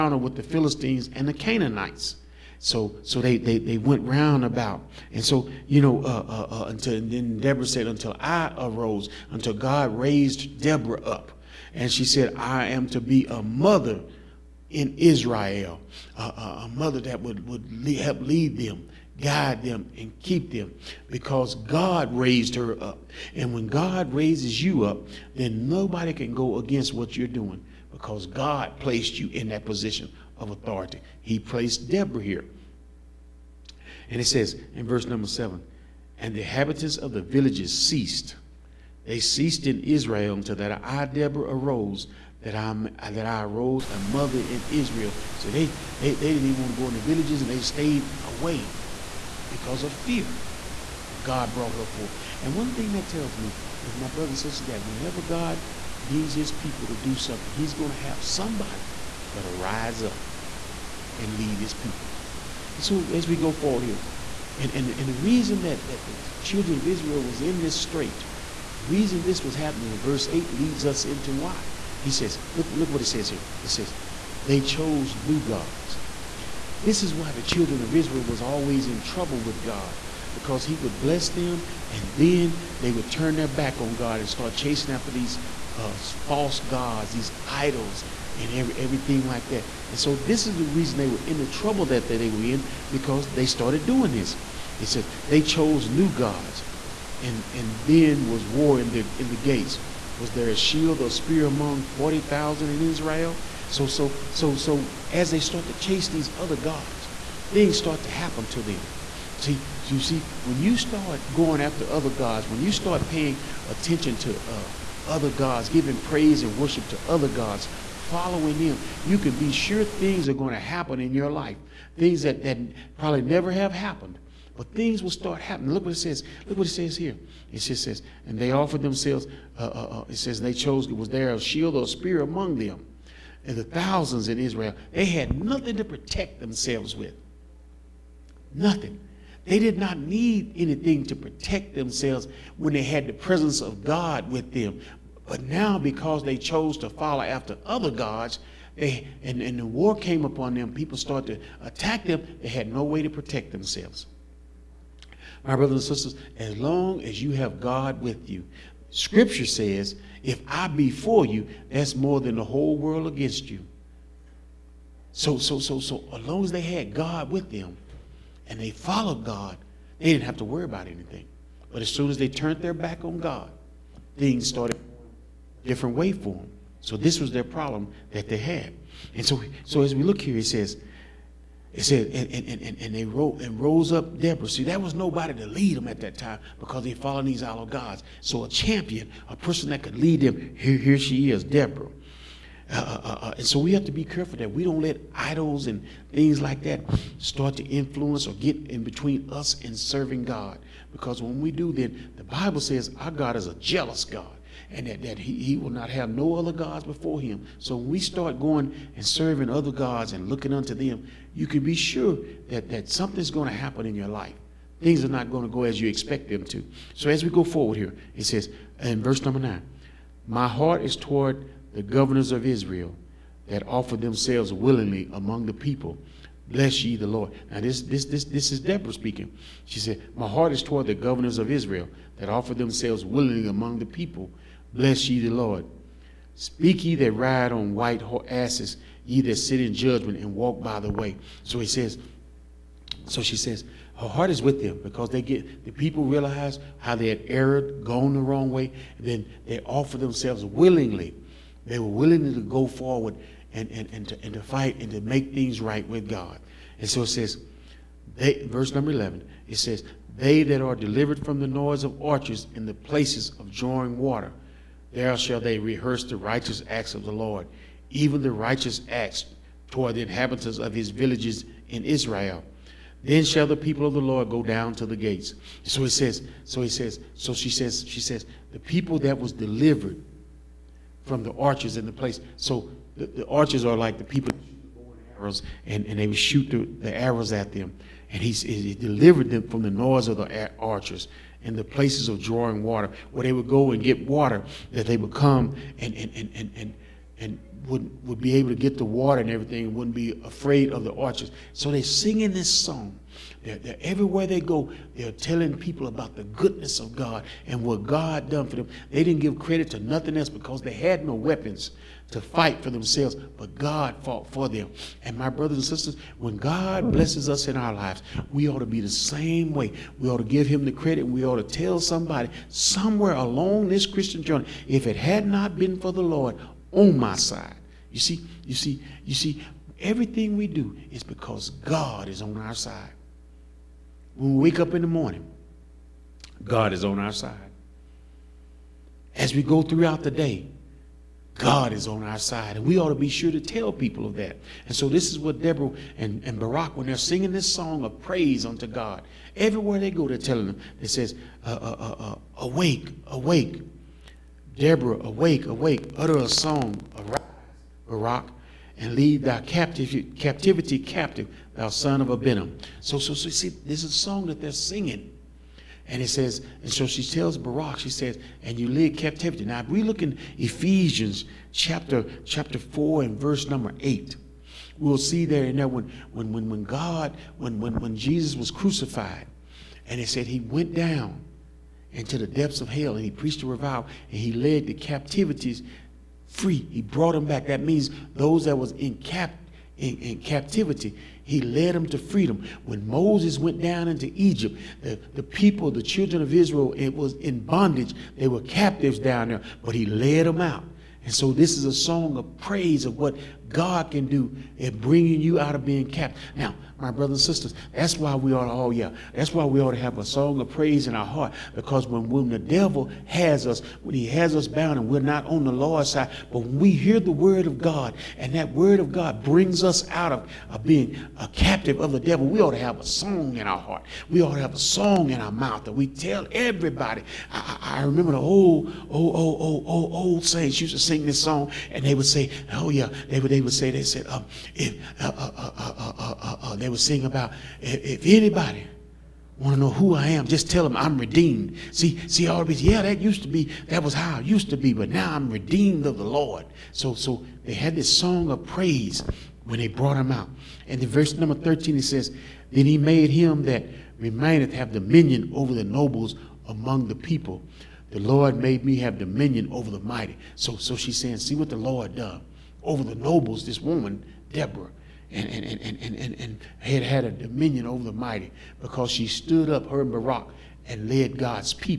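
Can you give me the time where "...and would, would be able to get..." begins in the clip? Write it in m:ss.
4:57.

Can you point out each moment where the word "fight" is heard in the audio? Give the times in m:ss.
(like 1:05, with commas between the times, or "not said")
4:14, 5:12.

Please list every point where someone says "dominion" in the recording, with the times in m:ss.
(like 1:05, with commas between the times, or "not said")
7:34, 7:38, 7:47.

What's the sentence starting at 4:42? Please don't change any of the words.
So the, the archers are like the people arrows, and, and they would shoot the, the arrows at them.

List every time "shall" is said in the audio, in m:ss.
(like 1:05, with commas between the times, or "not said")
4:25, 4:33.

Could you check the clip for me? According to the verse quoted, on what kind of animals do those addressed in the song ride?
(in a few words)
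white asses.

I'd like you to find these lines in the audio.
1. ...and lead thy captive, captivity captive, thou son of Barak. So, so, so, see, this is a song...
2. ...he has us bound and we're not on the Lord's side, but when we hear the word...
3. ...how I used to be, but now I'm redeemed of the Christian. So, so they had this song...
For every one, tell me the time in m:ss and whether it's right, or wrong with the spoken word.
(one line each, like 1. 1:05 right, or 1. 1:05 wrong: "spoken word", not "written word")
1. 5:58 wrong: "Abinoam", not "Barak"
2. 6:53 right
3. 7:23 wrong: "Lord", not "Christian".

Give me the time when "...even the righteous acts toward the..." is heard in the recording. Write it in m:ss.
4:27.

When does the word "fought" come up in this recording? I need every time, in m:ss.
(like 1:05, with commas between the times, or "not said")
5:14.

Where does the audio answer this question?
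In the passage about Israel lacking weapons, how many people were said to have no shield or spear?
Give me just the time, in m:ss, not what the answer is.
1:41.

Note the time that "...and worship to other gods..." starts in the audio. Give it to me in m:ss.
1:56.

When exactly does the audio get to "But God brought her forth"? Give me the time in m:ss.
0:51.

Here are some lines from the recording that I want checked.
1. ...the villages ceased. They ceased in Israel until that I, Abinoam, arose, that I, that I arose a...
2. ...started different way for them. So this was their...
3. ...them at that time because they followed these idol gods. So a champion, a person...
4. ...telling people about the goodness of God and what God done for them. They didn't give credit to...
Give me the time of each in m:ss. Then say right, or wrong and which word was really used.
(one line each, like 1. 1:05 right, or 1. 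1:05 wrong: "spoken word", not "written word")
1. 0:37 wrong: "Deborah", not "Abinoam"
2. 2:54 right
3. 3:05 right
4. 5:05 right.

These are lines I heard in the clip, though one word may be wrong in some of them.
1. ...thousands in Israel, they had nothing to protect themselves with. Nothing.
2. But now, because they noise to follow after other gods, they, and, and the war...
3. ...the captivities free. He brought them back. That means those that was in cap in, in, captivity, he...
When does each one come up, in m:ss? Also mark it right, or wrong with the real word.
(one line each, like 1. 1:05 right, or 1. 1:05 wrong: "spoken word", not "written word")
1. 2:13 right
2. 2:25 wrong: "chose", not "noise"
3. 6:24 right.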